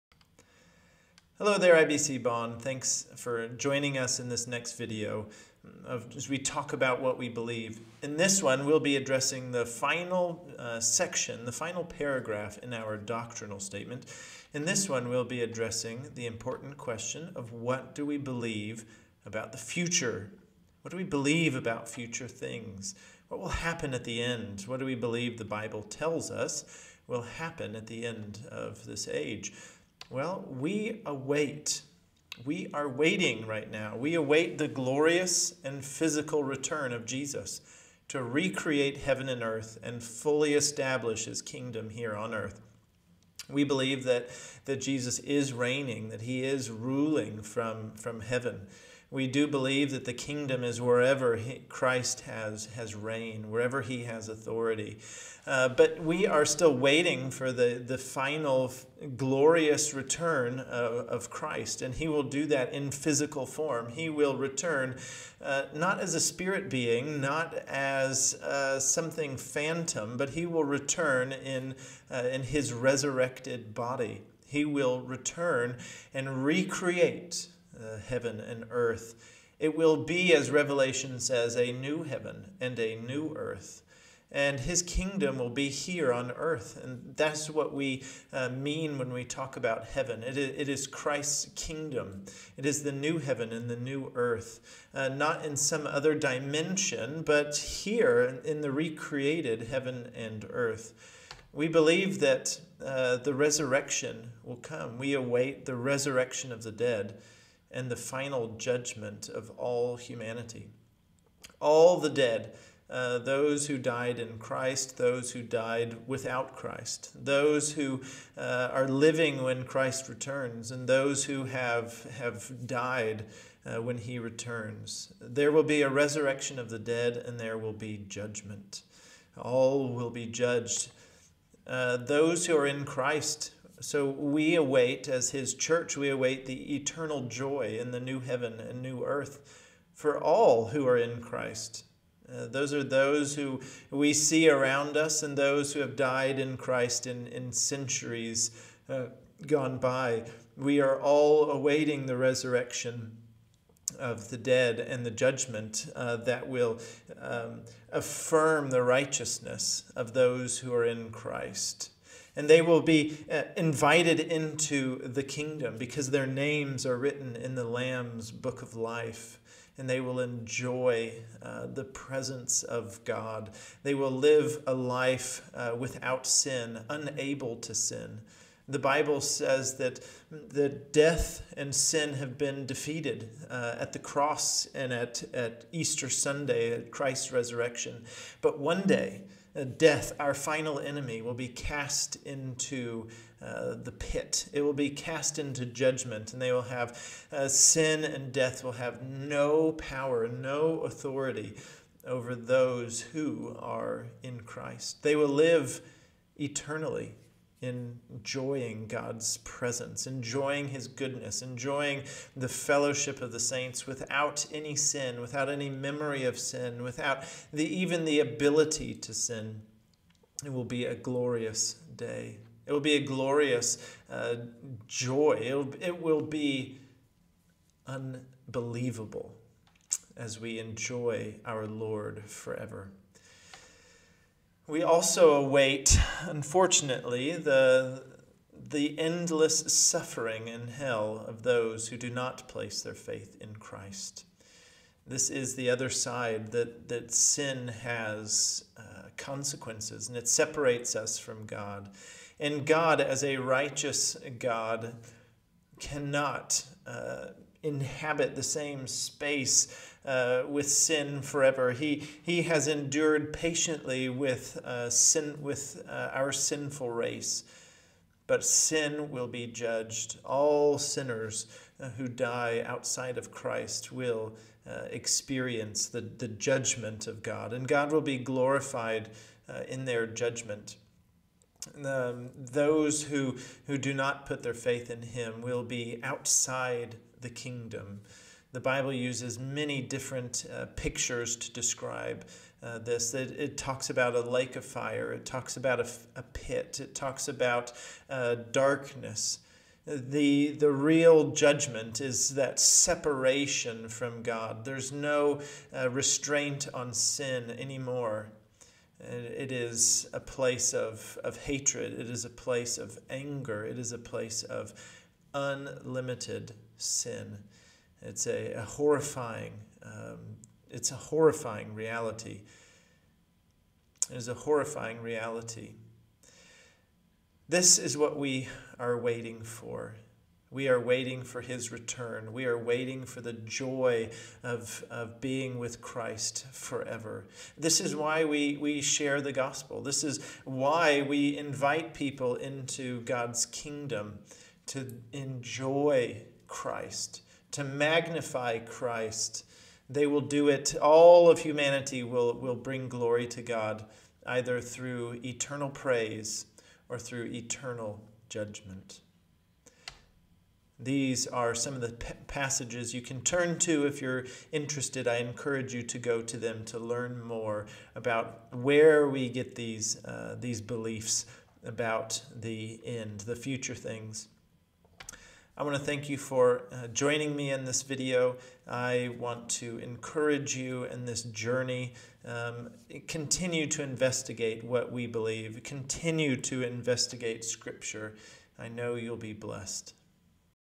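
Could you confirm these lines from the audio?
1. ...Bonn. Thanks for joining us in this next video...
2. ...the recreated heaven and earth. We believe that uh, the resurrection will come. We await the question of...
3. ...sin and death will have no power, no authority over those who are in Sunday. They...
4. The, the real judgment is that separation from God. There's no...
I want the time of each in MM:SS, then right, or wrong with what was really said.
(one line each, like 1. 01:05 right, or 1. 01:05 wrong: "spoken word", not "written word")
1. 00:02 right
2. 01:38 wrong: "resurrection", not "question"
3. 03:17 wrong: "Christ", not "Sunday"
4. 04:59 right.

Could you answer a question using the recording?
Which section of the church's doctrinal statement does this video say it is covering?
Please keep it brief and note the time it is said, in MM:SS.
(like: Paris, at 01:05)
The final paragraph, at 00:11.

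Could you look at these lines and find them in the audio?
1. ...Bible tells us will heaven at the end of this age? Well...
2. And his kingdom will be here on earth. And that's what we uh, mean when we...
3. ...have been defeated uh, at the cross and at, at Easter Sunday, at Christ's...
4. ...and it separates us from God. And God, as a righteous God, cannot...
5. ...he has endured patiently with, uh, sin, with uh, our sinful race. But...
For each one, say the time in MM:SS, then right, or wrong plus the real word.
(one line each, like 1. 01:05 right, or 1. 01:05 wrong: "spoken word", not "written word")
1. 00:25 wrong: "happen", not "heaven"
2. 01:24 right
3. 03:02 right
4. 04:10 right
5. 04:22 right.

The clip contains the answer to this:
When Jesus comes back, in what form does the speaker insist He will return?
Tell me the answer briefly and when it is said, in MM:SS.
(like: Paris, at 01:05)
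His resurrected body, at 01:12.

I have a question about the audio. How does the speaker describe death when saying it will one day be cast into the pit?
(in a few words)
Our final enemy.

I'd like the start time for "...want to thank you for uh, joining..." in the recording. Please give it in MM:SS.
06:15.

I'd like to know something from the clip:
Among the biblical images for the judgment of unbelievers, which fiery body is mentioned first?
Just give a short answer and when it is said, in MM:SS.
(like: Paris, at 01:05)
A lake of fire, at 04:54.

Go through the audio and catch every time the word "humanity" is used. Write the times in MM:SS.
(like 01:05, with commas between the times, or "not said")
01:49, 05:51.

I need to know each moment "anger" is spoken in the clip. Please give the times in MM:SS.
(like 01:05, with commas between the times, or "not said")
05:13.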